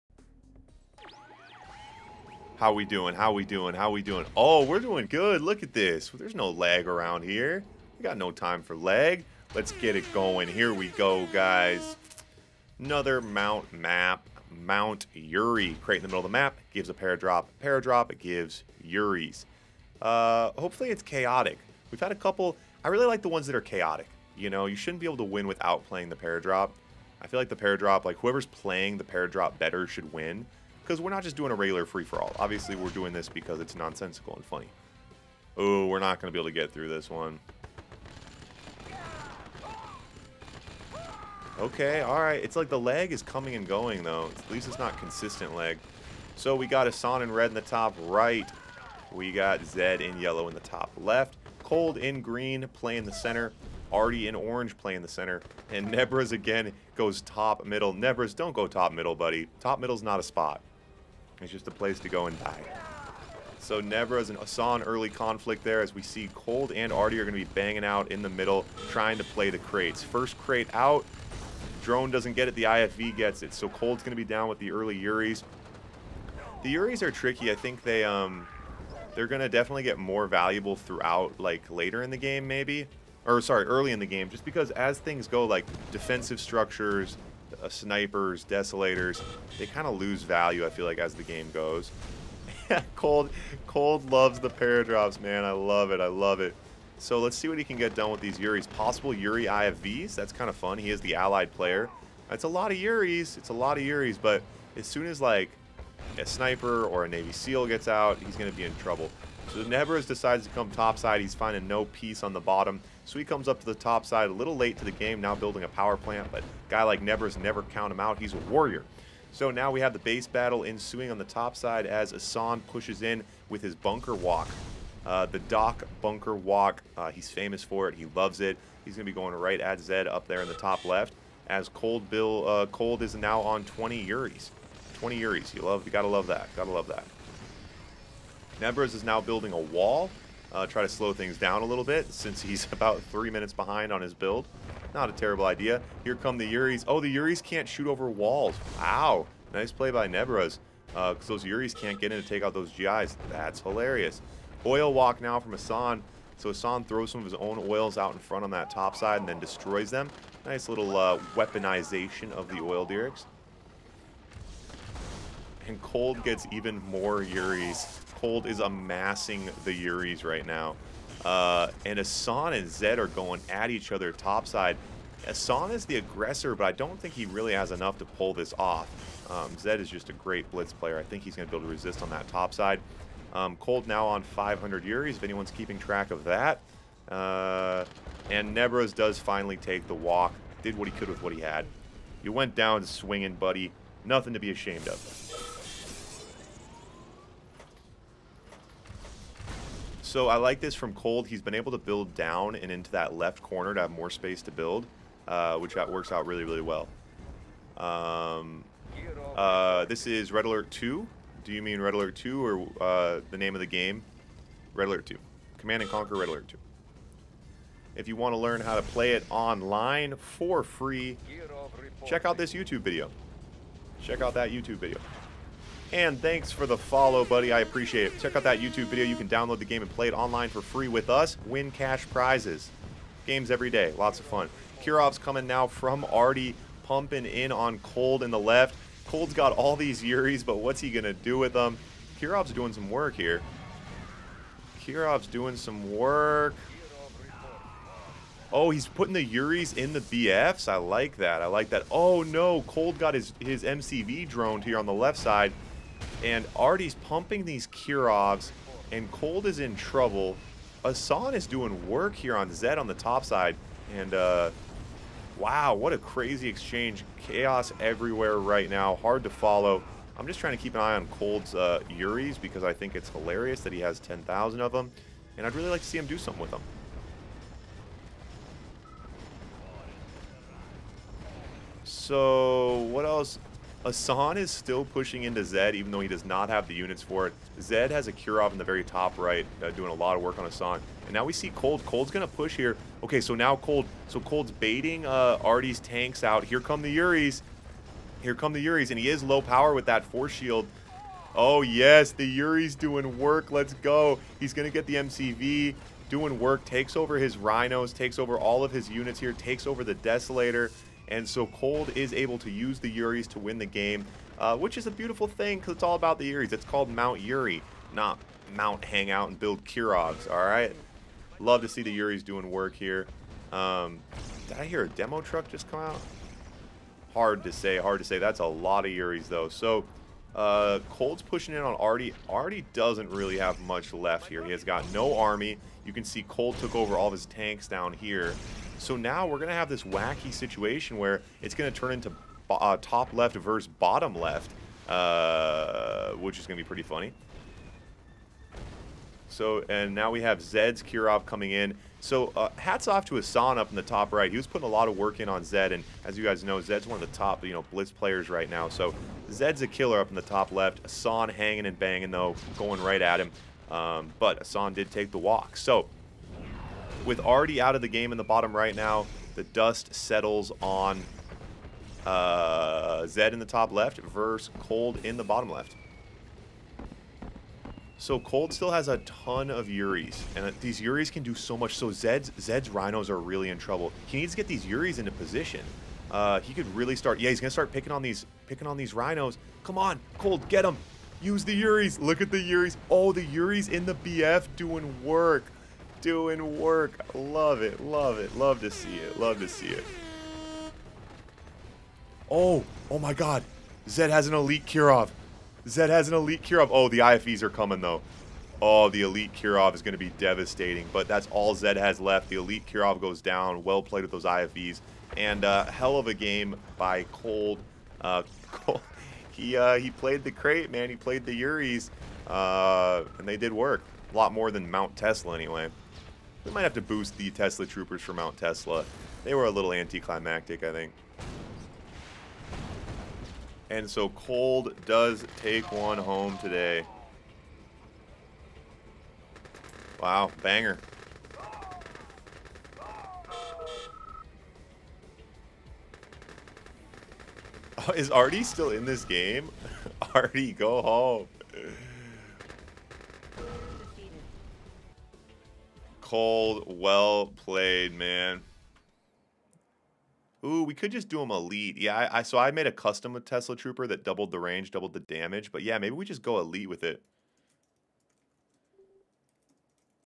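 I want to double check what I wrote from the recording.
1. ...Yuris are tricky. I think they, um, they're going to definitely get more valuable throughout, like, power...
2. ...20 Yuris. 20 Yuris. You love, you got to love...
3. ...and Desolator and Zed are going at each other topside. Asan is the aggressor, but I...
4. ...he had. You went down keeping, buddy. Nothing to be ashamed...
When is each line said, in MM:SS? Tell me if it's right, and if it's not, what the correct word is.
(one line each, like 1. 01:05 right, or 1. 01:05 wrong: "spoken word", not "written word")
1. 01:16 wrong: "later", not "power"
2. 02:13 right
3. 02:51 wrong: "Asan", not "Desolator"
4. 03:11 wrong: "swinging", not "keeping".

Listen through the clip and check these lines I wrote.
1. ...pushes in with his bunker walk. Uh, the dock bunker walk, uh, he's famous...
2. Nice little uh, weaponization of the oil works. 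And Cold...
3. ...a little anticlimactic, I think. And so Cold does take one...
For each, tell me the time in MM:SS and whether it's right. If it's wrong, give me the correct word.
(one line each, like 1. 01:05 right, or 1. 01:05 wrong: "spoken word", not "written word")
1. 02:02 right
2. 02:40 wrong: "derricks", not "works"
3. 07:09 right.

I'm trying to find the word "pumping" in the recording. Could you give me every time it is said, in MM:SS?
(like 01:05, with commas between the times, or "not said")
03:56, 04:16.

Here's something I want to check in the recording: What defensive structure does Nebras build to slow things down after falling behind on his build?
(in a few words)
a wall.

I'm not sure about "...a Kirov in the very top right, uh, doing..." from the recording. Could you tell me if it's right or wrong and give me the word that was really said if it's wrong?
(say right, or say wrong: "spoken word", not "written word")
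right.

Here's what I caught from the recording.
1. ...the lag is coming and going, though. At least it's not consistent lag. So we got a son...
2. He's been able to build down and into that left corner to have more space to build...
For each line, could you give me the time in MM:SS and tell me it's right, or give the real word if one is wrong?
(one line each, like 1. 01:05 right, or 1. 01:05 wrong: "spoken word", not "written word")
1. 00:42 right
2. 03:21 right.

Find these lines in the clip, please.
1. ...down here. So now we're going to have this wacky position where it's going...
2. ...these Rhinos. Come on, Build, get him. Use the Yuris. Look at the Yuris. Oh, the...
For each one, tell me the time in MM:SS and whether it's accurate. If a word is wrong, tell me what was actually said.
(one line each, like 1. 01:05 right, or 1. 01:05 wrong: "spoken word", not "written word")
1. 05:37 wrong: "situation", not "position"
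2. 06:28 wrong: "Cold", not "Build".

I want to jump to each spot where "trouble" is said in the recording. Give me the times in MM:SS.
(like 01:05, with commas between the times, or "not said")
01:48, 04:19, 06:23.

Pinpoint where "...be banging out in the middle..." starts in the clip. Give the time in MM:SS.
01:07.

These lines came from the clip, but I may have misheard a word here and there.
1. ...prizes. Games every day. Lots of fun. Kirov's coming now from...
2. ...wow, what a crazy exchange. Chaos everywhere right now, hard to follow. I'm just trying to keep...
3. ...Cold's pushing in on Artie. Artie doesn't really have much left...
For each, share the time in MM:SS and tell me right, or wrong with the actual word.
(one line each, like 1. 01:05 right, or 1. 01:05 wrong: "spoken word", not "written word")
1. 03:52 right
2. 04:25 right
3. 05:30 right.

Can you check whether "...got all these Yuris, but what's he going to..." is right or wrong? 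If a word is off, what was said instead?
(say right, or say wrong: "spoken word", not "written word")
right.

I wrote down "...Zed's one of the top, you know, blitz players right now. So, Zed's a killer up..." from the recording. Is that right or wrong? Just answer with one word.
right.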